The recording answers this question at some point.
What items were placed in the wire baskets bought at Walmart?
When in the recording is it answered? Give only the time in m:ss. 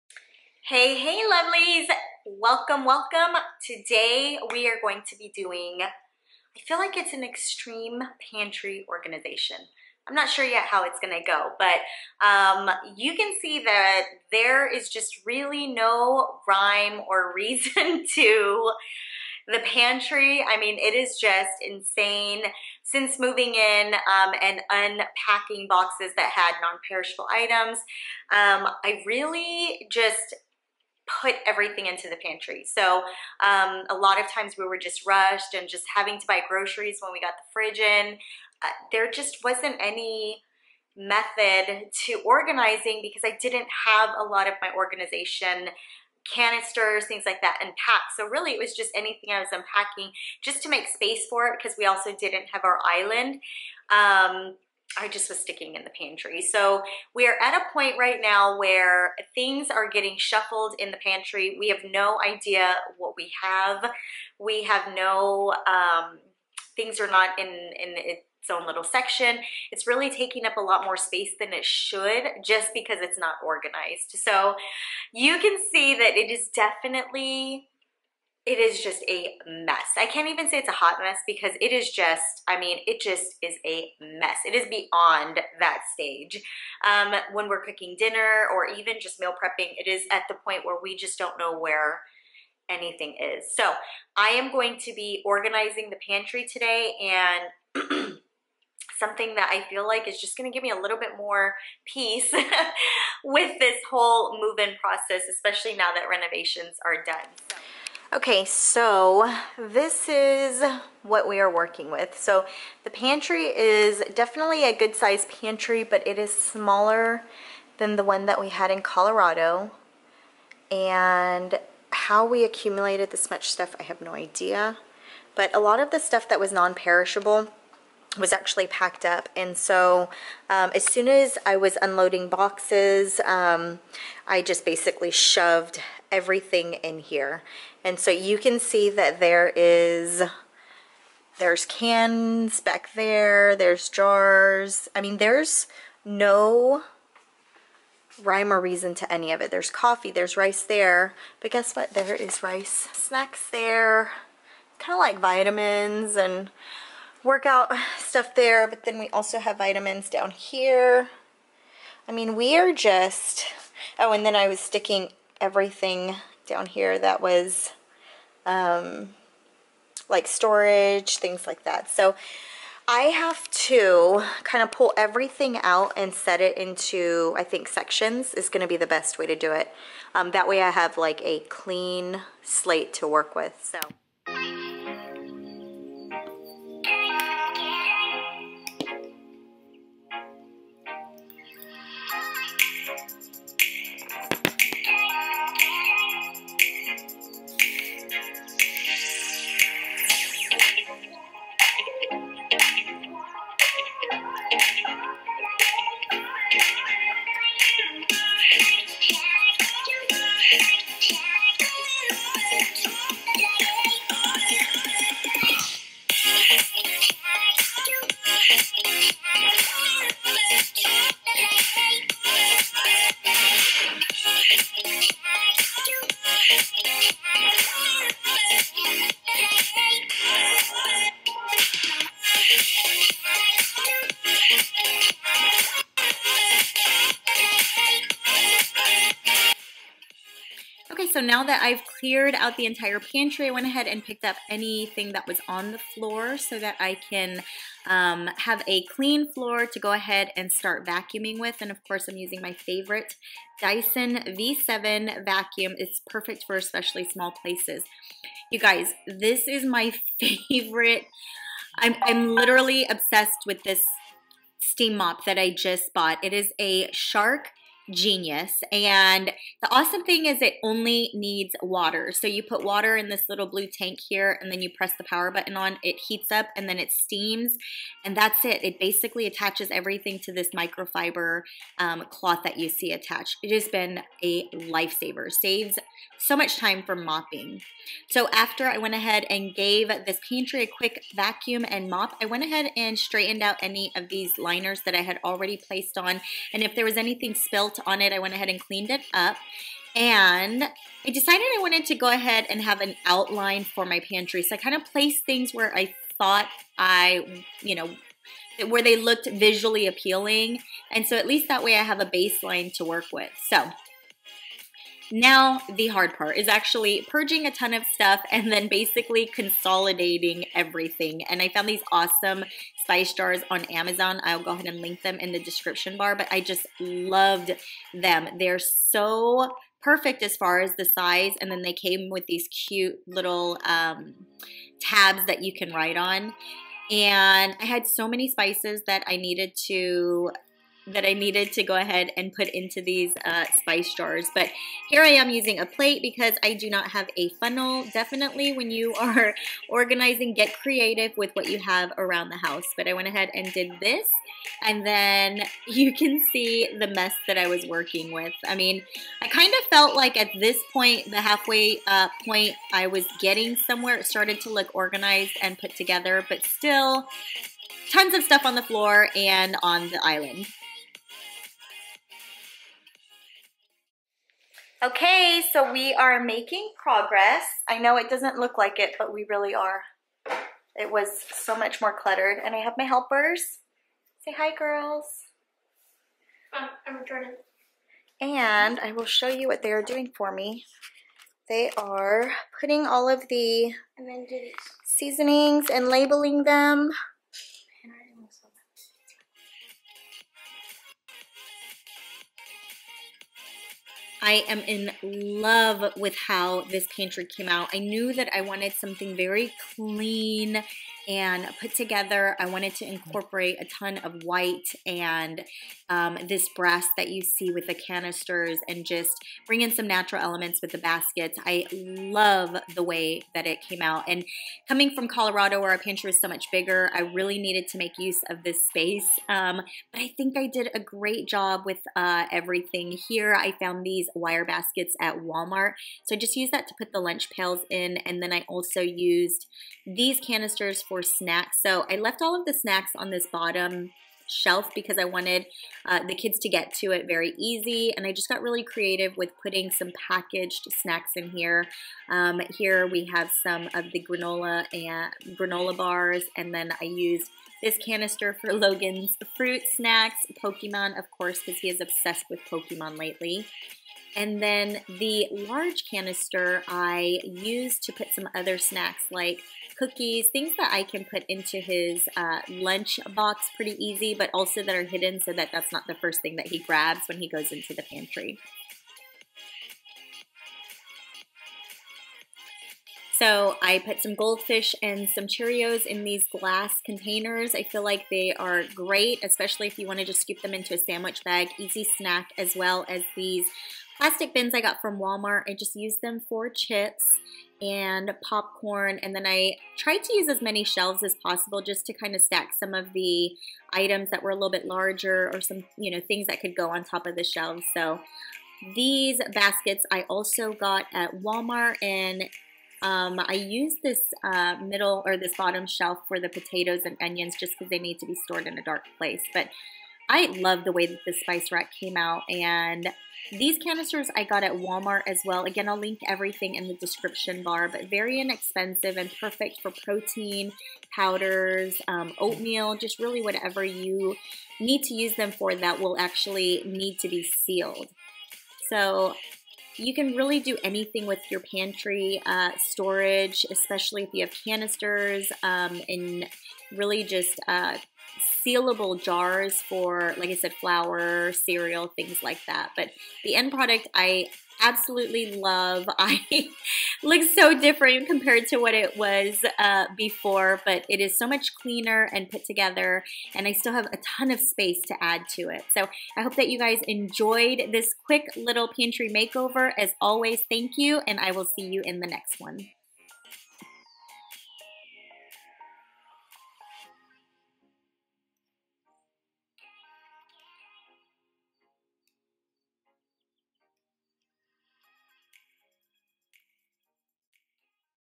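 7:16.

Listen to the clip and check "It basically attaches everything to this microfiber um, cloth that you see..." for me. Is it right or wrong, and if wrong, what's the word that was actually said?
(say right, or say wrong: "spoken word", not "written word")
right.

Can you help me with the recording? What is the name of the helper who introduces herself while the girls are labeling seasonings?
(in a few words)
Jordan.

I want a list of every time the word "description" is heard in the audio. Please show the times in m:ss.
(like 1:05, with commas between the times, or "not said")
5:25, 8:46.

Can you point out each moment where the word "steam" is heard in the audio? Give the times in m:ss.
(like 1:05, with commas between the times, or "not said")
4:24, 4:36.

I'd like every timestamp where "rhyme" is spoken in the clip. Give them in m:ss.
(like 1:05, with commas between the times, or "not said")
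0:16, 2:28.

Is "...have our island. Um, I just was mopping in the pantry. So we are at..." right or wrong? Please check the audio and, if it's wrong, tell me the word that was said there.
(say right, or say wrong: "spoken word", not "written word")
wrong: "sticking", not "mopping".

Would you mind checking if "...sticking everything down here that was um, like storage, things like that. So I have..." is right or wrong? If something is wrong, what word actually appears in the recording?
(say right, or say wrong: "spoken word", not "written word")
right.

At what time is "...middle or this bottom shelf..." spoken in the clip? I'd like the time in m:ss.
8:34.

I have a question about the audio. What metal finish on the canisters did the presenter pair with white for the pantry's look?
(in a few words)
Brass.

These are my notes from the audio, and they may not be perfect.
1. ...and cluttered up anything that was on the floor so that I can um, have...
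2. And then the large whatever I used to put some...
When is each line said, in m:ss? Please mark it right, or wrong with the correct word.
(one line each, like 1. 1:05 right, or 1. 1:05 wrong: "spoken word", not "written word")
1. 4:03 wrong: "picked", not "cluttered"
2. 7:44 wrong: "canister", not "whatever".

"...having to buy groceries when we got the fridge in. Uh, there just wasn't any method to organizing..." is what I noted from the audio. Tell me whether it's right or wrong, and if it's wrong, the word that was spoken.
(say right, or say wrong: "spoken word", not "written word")
right.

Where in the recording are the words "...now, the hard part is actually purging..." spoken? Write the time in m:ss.
5:15.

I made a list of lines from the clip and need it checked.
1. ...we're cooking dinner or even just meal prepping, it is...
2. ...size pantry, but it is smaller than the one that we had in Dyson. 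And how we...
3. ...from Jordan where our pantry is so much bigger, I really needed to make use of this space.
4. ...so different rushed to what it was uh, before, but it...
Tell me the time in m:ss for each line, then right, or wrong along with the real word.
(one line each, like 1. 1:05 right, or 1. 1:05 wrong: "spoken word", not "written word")
1. 1:27 right
2. 1:54 wrong: "Colorado", not "Dyson"
3. 7:04 wrong: "Colorado", not "Jordan"
4. 9:17 wrong: "compared", not "rushed".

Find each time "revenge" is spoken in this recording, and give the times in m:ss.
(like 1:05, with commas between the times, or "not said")
not said.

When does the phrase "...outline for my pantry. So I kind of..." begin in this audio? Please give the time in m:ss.
5:03.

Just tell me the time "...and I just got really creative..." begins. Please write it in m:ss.
7:27.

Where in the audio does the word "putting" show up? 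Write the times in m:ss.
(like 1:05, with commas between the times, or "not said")
6:32, 7:29.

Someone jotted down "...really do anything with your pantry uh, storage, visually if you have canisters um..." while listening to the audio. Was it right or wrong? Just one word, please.
wrong.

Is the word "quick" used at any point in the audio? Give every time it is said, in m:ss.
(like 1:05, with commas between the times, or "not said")
4:50, 9:28.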